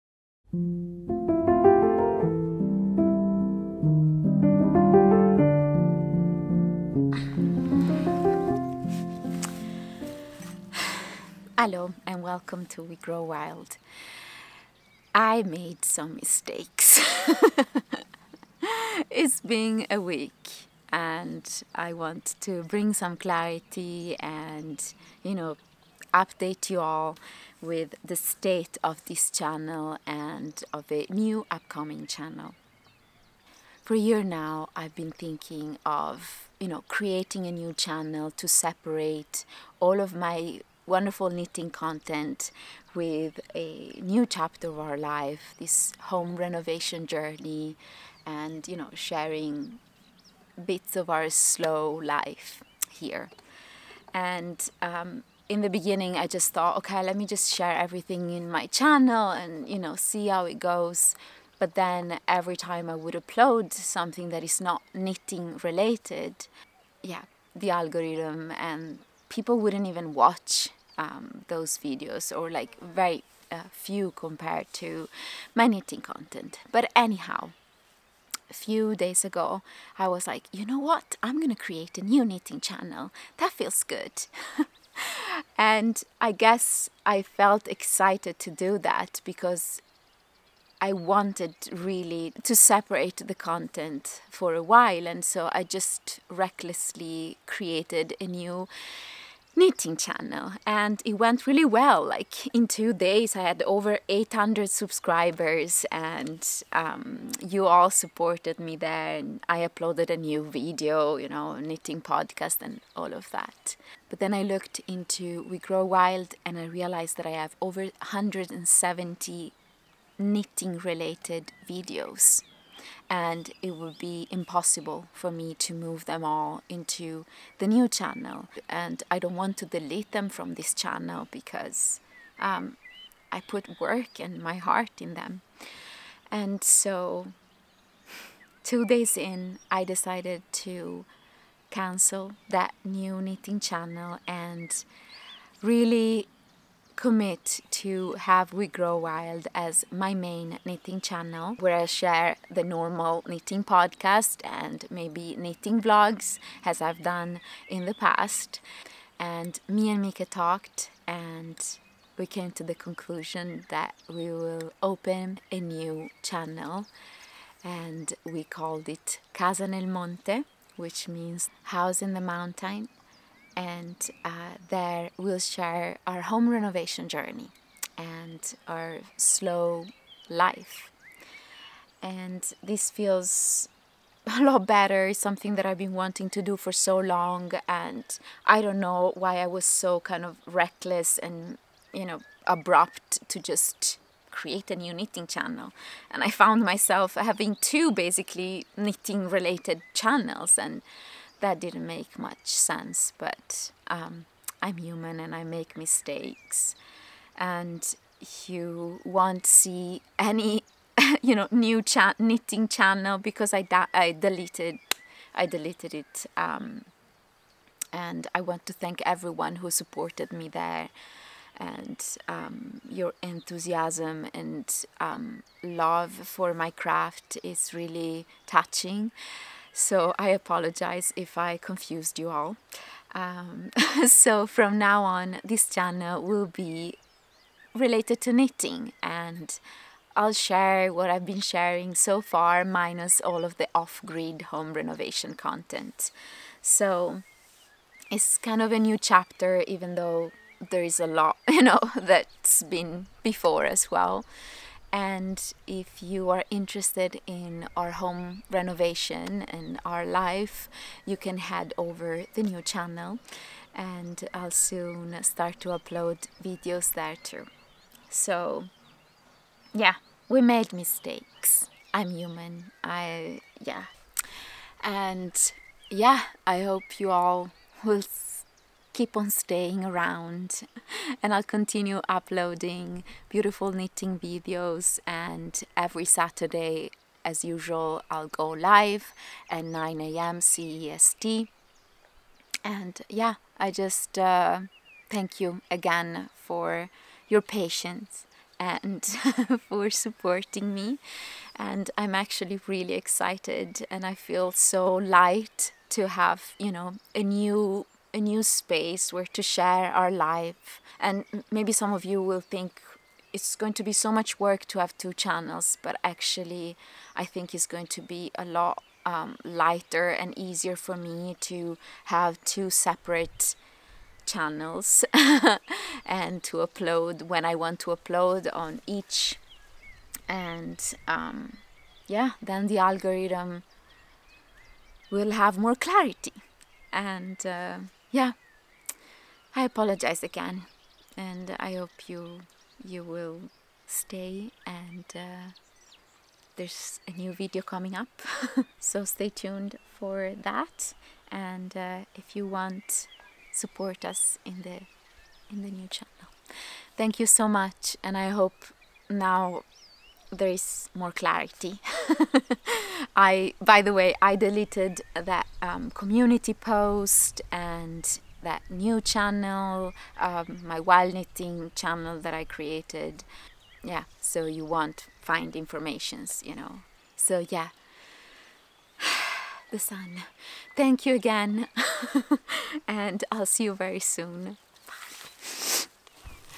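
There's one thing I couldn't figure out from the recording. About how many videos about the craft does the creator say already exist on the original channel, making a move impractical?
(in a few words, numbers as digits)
170.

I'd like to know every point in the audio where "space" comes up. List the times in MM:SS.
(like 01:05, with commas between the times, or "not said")
05:08.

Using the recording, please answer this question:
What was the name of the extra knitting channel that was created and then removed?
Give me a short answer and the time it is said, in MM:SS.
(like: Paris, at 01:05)
My Wild Knitting, at 06:10.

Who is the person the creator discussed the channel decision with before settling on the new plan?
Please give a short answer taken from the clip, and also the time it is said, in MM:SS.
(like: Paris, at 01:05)
Mika, at 02:40.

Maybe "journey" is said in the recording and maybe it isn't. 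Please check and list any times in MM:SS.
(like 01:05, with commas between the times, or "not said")
00:47, 02:57.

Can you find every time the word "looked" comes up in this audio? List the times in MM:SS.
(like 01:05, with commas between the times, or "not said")
01:54.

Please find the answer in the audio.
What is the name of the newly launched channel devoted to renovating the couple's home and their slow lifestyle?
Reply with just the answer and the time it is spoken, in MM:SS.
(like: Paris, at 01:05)
Casa nel Monte, at 02:49.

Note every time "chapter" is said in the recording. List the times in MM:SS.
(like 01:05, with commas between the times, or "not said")
00:44, 04:08.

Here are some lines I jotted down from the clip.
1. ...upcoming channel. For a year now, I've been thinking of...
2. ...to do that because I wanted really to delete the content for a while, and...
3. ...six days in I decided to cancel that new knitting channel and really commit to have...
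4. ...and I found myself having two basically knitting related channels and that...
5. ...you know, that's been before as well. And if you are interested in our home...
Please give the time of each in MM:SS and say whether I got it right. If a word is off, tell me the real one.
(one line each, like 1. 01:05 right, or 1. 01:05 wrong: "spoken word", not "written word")
1. 00:31 right
2. 01:28 wrong: "separate", not "delete"
3. 02:18 wrong: "two", not "six"
4. 03:16 right
5. 04:11 right.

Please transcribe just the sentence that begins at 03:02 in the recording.
And this feels a lot better.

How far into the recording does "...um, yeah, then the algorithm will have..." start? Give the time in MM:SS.
05:31.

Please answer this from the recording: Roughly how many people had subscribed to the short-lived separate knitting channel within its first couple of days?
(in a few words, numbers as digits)
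800.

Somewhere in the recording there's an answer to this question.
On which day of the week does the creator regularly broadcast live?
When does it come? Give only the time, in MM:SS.
04:45.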